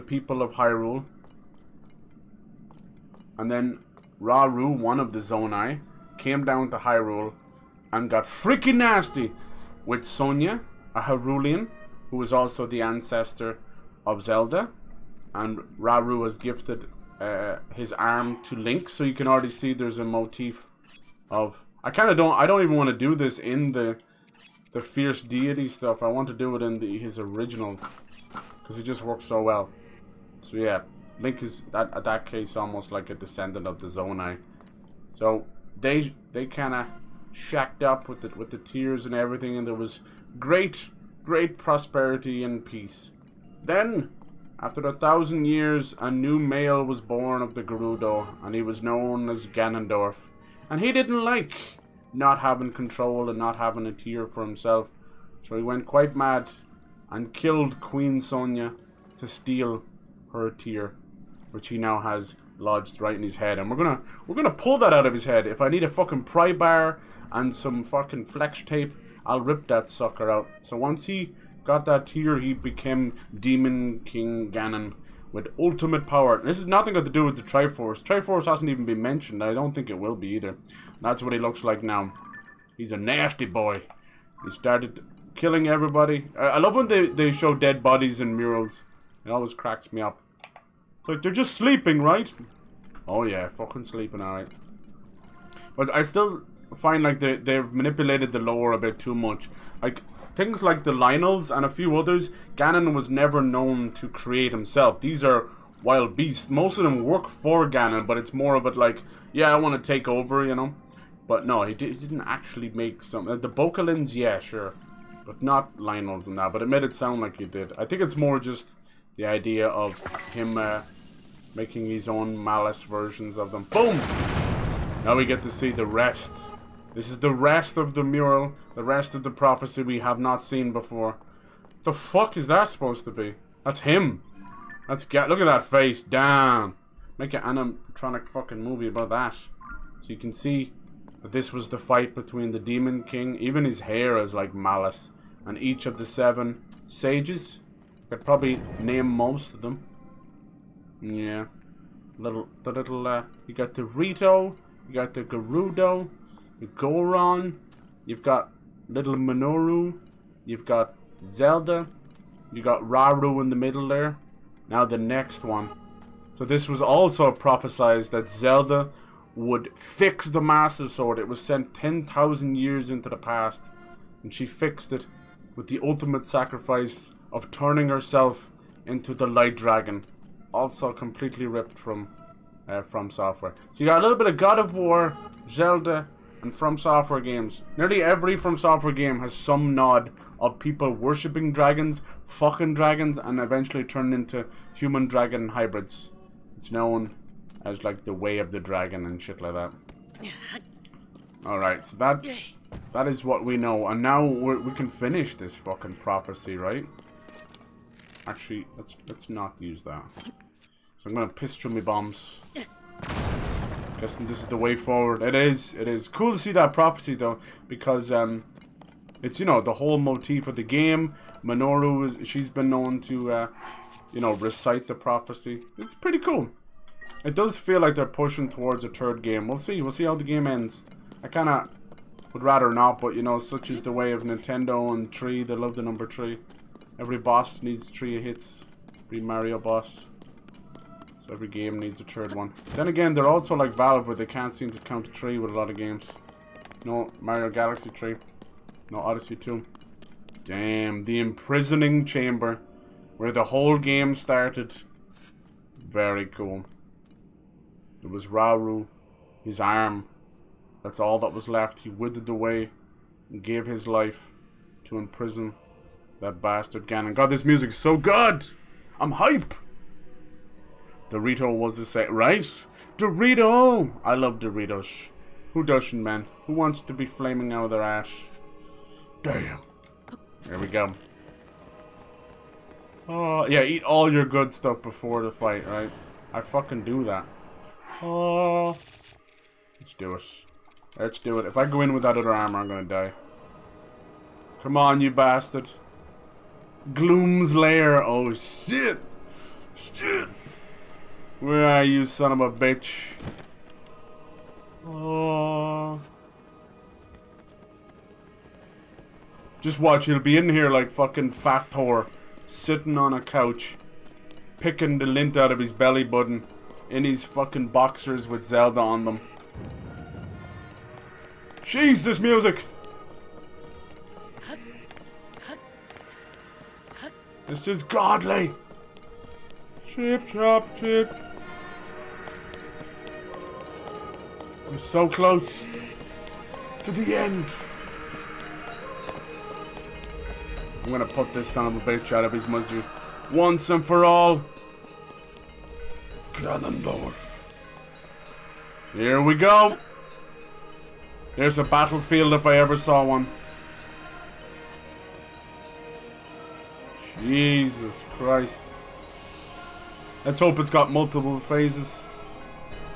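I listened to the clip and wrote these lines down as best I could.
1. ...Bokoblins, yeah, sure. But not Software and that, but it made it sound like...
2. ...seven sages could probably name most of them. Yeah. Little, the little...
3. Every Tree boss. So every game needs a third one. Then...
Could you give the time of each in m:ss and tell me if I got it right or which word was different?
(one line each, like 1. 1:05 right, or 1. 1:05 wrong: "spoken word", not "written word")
1. 1:53 wrong: "Lynels", not "Software"
2. 2:26 right
3. 3:59 wrong: "Mario", not "Tree".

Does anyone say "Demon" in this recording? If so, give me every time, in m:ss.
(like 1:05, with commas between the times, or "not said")
1:13, 2:22.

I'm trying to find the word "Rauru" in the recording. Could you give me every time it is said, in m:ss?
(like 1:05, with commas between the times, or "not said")
0:04, 0:15, 2:42, 4:18.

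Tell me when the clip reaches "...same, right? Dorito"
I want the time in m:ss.
4:31.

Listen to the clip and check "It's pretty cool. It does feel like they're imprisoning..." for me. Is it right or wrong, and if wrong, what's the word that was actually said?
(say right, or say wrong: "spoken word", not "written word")
wrong: "pushing", not "imprisoning".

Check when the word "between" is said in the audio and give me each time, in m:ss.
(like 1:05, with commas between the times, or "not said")
2:22.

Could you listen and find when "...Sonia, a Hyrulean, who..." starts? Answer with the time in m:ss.
0:10.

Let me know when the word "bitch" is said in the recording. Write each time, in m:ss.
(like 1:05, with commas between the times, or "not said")
5:02, 5:41.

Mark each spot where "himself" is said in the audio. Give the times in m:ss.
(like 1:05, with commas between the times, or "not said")
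0:54, 1:44.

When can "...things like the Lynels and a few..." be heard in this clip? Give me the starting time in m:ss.
1:40.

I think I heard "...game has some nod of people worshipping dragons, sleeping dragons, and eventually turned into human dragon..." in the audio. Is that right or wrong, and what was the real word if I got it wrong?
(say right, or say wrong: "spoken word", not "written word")
wrong: "fucking", not "sleeping".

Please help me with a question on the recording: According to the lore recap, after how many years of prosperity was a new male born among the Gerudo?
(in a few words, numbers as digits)
1000.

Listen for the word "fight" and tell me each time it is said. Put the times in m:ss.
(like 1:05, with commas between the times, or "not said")
2:21, 4:45.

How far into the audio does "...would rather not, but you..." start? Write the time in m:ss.
3:52.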